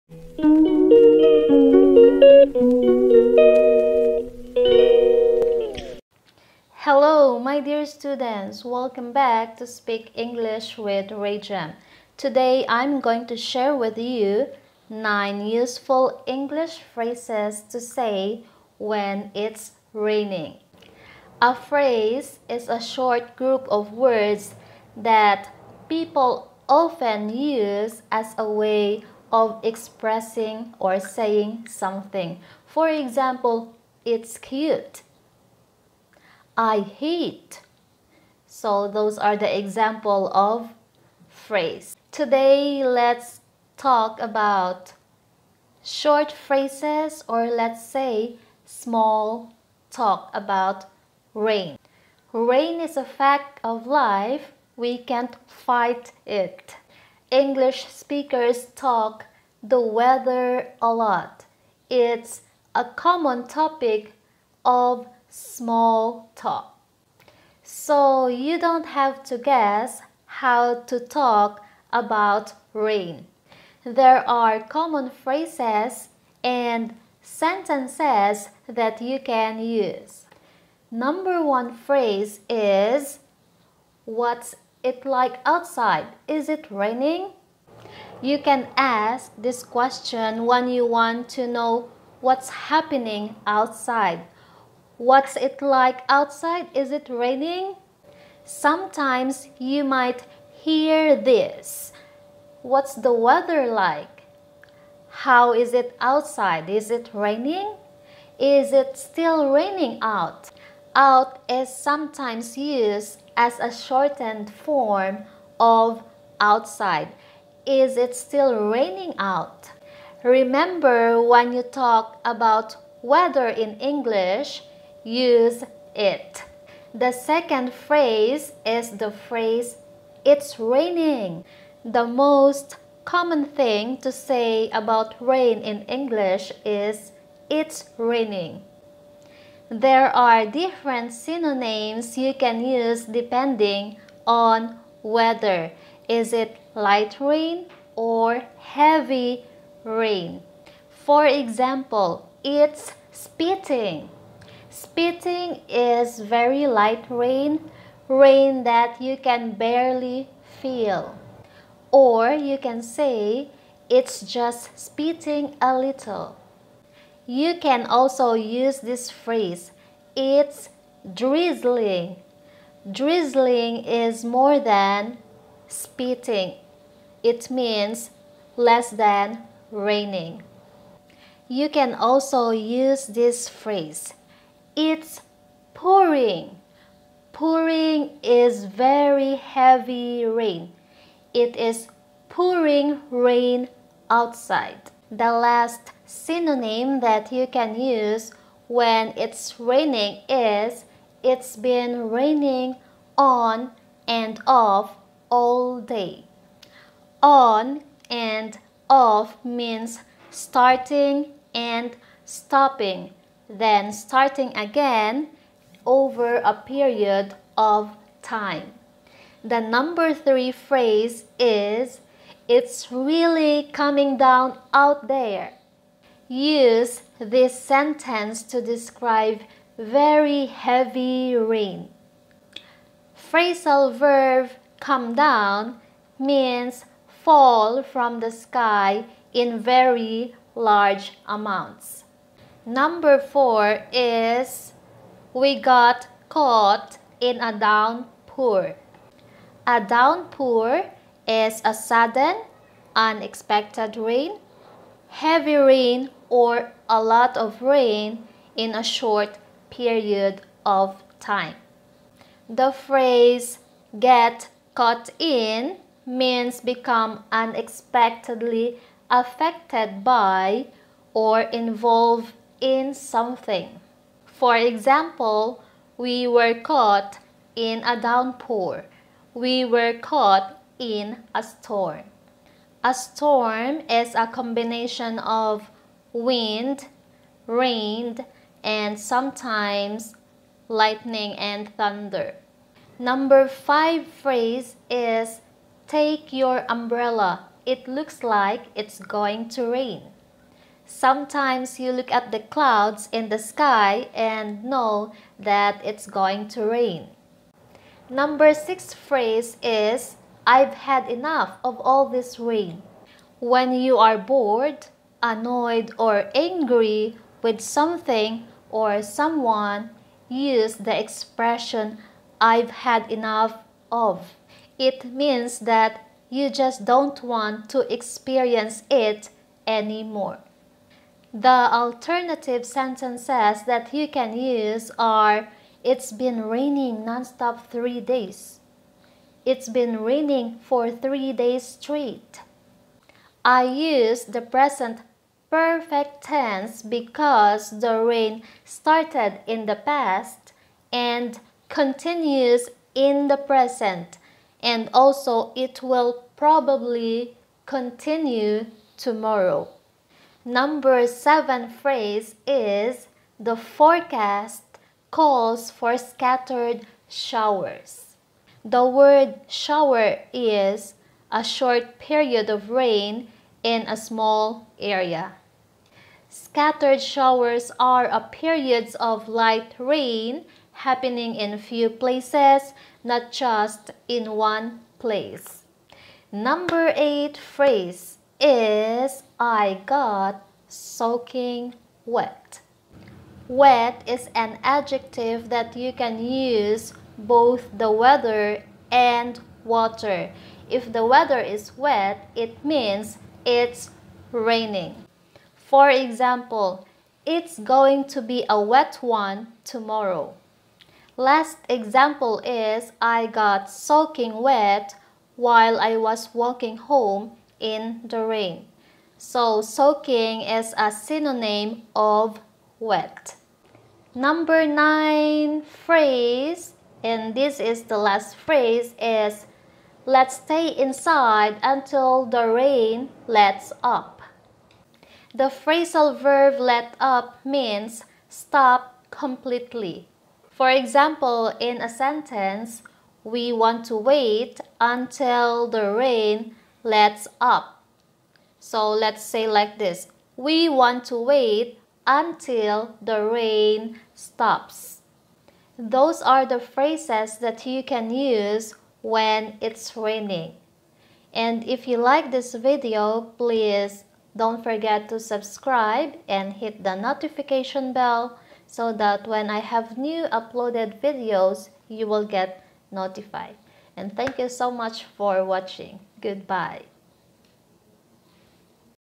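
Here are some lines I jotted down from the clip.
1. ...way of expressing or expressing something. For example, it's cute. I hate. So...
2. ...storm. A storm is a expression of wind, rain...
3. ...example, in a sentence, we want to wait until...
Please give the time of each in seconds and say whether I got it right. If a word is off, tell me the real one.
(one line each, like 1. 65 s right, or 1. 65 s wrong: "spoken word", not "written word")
1. 28 s wrong: "saying", not "expressing"
2. 281 s wrong: "combination", not "expression"
3. 440 s right.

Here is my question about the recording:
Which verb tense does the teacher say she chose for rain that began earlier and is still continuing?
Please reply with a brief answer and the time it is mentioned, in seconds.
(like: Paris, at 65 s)
present perfect tense, at 344 s.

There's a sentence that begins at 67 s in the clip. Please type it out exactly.
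So you don't have to guess how to talk about rain.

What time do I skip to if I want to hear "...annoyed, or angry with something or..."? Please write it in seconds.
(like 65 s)
315 s.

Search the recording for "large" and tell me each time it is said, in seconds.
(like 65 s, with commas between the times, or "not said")
240 s.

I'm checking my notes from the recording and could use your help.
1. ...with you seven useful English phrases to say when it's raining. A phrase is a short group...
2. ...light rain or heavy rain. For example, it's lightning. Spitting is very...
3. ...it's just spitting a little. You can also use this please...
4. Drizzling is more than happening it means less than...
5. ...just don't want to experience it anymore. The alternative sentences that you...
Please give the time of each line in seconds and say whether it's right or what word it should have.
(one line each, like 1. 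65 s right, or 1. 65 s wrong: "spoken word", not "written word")
1. 13 s wrong: "nine", not "seven"
2. 146 s wrong: "spitting", not "lightning"
3. 163 s wrong: "phrase", not "please"
4. 172 s wrong: "spitting", not "happening"
5. 326 s right.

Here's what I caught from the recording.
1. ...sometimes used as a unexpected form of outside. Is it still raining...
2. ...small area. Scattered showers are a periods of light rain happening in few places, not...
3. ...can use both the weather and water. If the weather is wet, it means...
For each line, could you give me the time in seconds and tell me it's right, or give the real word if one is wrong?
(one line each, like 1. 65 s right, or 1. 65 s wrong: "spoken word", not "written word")
1. 111 s wrong: "shortened", not "unexpected"
2. 373 s right
3. 395 s right.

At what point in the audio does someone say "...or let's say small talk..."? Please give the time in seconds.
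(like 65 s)
47 s.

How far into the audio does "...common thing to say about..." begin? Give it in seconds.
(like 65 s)
133 s.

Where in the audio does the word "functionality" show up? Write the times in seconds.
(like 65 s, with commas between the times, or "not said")
not said.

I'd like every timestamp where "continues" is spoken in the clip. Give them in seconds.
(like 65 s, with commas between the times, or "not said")
351 s, 357 s.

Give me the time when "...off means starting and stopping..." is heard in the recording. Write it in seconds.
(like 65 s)
208 s.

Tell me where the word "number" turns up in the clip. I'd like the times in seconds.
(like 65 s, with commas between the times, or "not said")
80 s, 219 s, 242 s, 292 s, 308 s, 360 s, 386 s, 424 s.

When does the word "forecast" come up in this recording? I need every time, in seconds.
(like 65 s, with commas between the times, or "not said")
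363 s.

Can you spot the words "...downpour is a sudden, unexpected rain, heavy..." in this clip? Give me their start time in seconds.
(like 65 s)
249 s.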